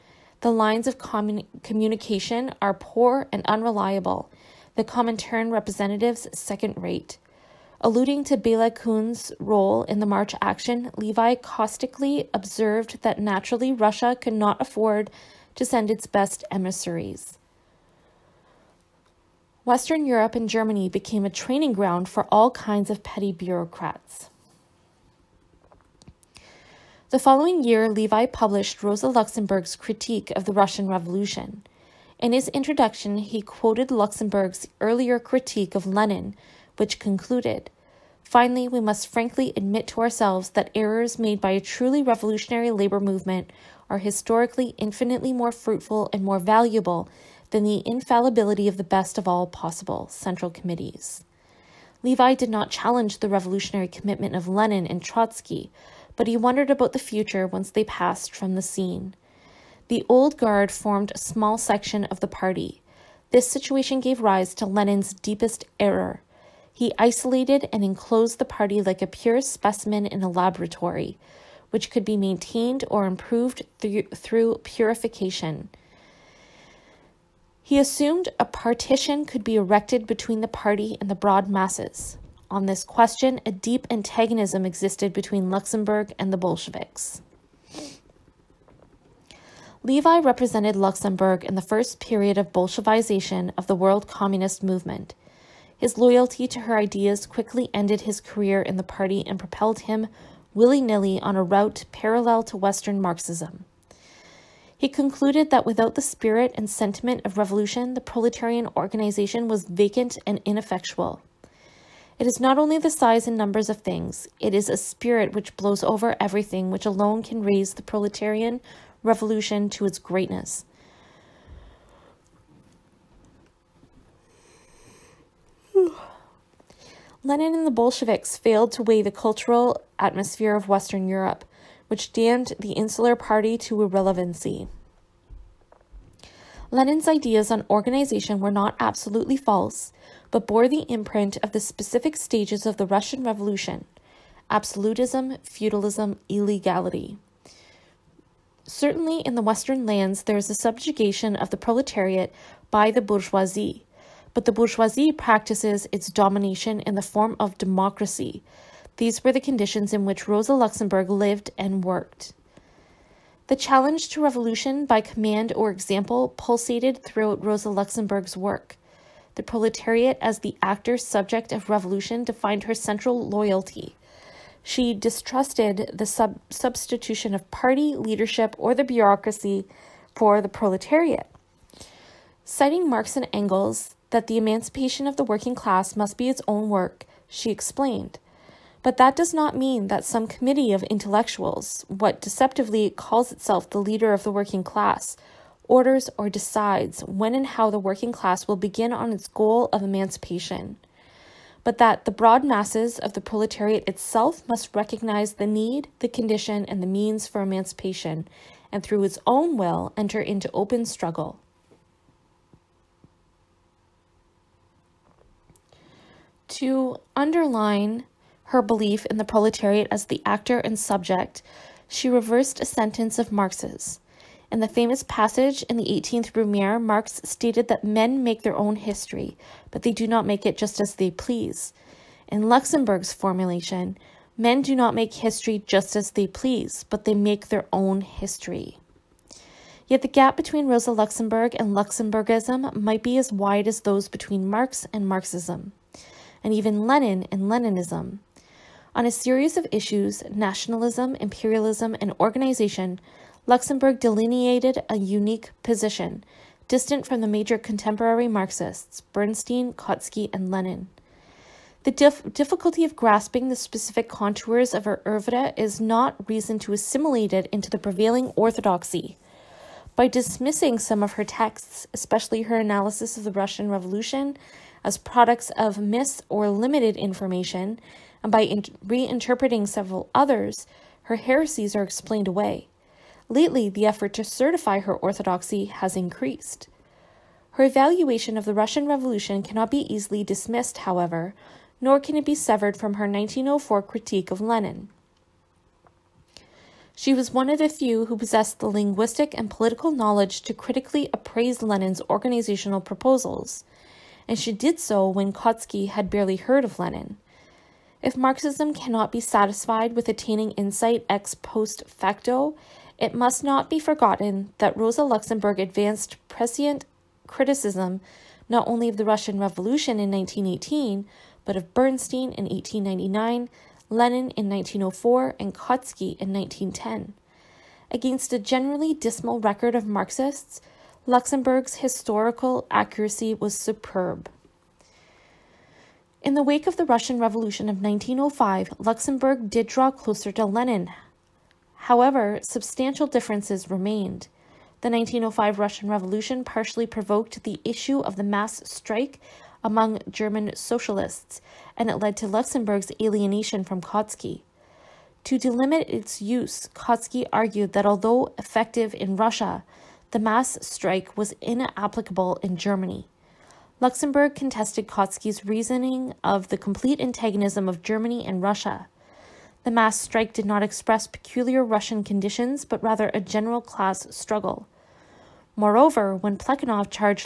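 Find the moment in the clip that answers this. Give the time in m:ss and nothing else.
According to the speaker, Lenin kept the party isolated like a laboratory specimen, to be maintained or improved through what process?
1:14.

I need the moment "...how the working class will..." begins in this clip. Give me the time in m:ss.
3:17.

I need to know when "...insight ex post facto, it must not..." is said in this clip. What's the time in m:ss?
5:10.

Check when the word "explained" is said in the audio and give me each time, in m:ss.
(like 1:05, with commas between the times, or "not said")
3:07, 4:41.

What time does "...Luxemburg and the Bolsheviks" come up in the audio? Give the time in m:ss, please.
1:25.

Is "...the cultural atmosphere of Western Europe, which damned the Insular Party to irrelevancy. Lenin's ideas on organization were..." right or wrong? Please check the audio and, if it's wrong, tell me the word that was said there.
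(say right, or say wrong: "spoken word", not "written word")
right.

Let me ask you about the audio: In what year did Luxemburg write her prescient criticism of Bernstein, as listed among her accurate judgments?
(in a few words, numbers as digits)
1899.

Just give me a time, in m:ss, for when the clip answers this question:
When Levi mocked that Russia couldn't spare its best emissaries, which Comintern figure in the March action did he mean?
0:08.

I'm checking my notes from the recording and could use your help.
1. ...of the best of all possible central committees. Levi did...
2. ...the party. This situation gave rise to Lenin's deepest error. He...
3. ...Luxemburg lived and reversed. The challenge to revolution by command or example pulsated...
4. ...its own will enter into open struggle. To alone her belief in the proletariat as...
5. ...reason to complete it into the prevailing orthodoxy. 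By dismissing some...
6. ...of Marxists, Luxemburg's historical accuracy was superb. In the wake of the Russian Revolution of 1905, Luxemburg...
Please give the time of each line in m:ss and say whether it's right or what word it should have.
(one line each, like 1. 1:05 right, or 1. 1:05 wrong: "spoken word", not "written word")
1. 0:48 right
2. 1:02 right
3. 2:40 wrong: "worked", not "reversed"
4. 3:29 wrong: "underline", not "alone"
5. 4:26 wrong: "assimilate", not "complete"
6. 5:29 right.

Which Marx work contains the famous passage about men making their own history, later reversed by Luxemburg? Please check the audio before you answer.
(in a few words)
18th Brumaire.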